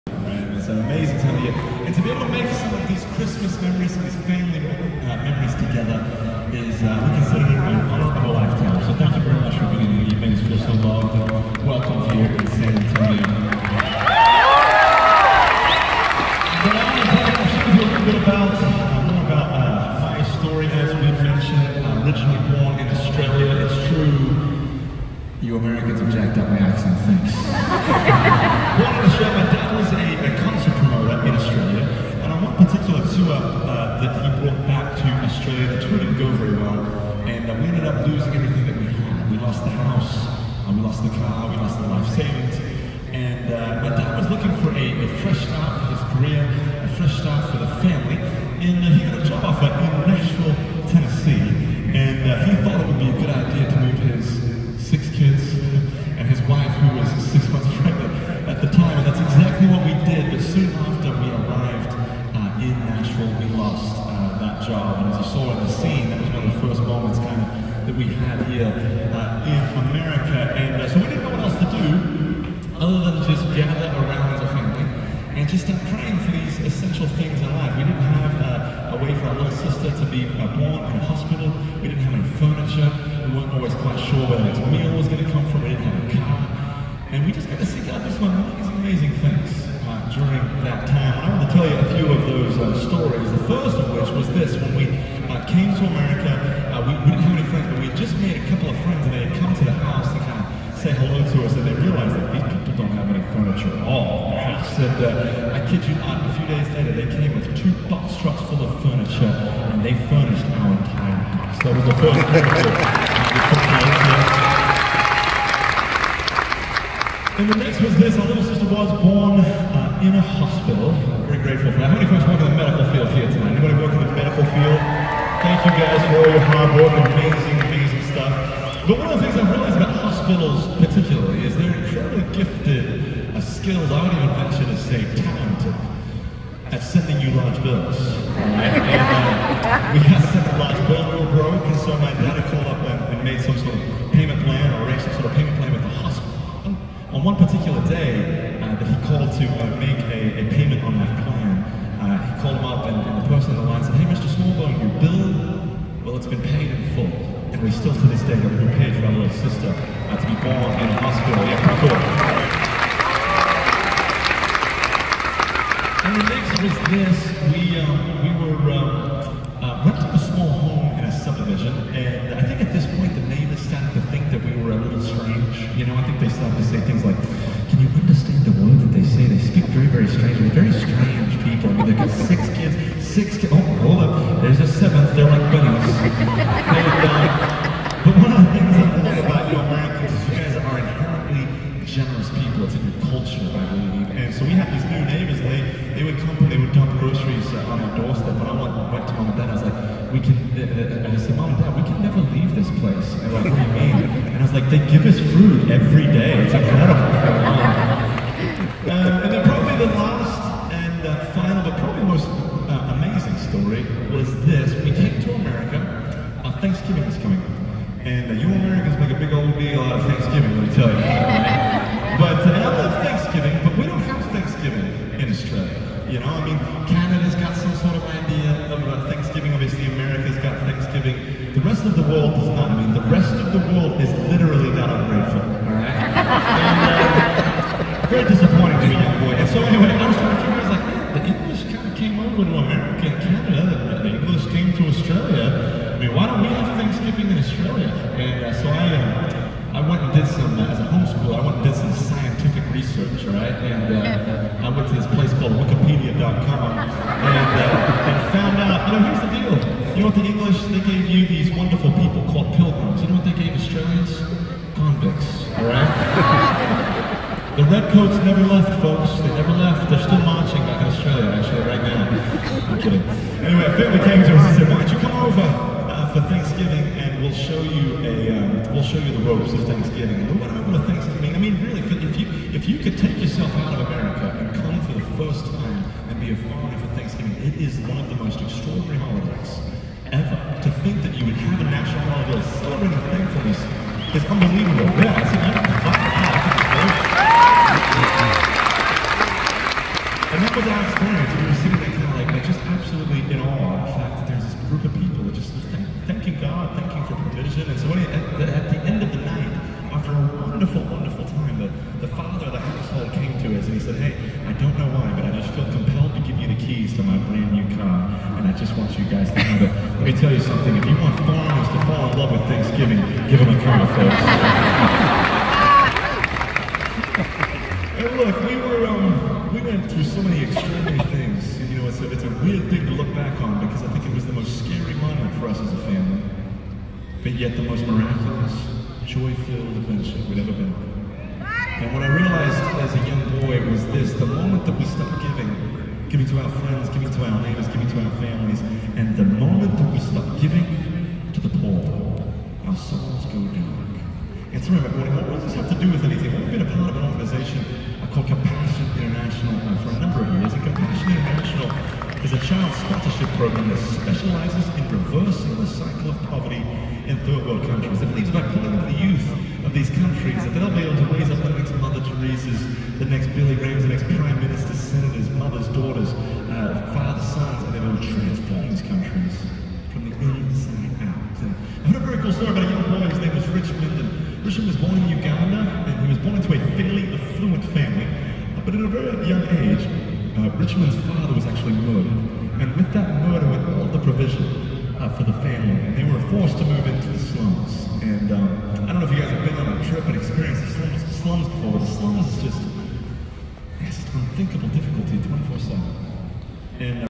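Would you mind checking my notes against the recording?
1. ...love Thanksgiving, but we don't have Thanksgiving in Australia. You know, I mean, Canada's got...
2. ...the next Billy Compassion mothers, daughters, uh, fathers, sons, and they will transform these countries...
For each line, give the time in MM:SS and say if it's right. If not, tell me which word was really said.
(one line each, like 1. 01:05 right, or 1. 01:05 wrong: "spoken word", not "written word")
1. 03:42 right
2. 06:12 wrong: "Graham", not "Compassion".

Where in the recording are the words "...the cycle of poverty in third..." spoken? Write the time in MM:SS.
06:05.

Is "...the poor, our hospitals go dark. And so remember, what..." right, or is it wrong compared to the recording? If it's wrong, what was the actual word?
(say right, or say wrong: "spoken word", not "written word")
wrong: "souls", not "hospitals".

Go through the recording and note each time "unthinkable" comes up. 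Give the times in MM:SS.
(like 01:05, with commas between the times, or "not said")
06:44.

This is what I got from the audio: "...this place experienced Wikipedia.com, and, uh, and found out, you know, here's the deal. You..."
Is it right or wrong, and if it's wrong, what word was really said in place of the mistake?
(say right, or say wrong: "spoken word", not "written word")
wrong: "called", not "experienced".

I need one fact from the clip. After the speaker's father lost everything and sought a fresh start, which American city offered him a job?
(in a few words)
Nashville.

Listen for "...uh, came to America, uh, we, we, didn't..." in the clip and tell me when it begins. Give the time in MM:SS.
01:35.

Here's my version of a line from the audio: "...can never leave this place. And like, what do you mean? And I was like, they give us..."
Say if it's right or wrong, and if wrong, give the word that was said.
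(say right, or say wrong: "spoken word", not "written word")
right.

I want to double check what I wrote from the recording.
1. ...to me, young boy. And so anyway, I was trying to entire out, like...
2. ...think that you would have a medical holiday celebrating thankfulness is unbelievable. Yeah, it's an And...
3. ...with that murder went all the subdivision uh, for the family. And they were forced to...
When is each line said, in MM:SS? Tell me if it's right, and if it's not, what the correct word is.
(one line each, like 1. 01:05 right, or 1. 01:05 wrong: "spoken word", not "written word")
1. 03:58 wrong: "figure", not "entire"
2. 04:50 wrong: "national", not "medical"
3. 06:32 wrong: "provision", not "subdivision".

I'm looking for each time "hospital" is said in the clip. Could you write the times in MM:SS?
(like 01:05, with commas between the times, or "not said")
01:21, 02:00, 02:09, 02:40.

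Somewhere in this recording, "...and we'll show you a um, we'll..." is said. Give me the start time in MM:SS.
04:36.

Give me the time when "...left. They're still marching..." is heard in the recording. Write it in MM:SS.
04:29.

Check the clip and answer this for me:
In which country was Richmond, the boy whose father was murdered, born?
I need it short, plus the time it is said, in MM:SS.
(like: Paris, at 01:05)
Uganda, at 06:25.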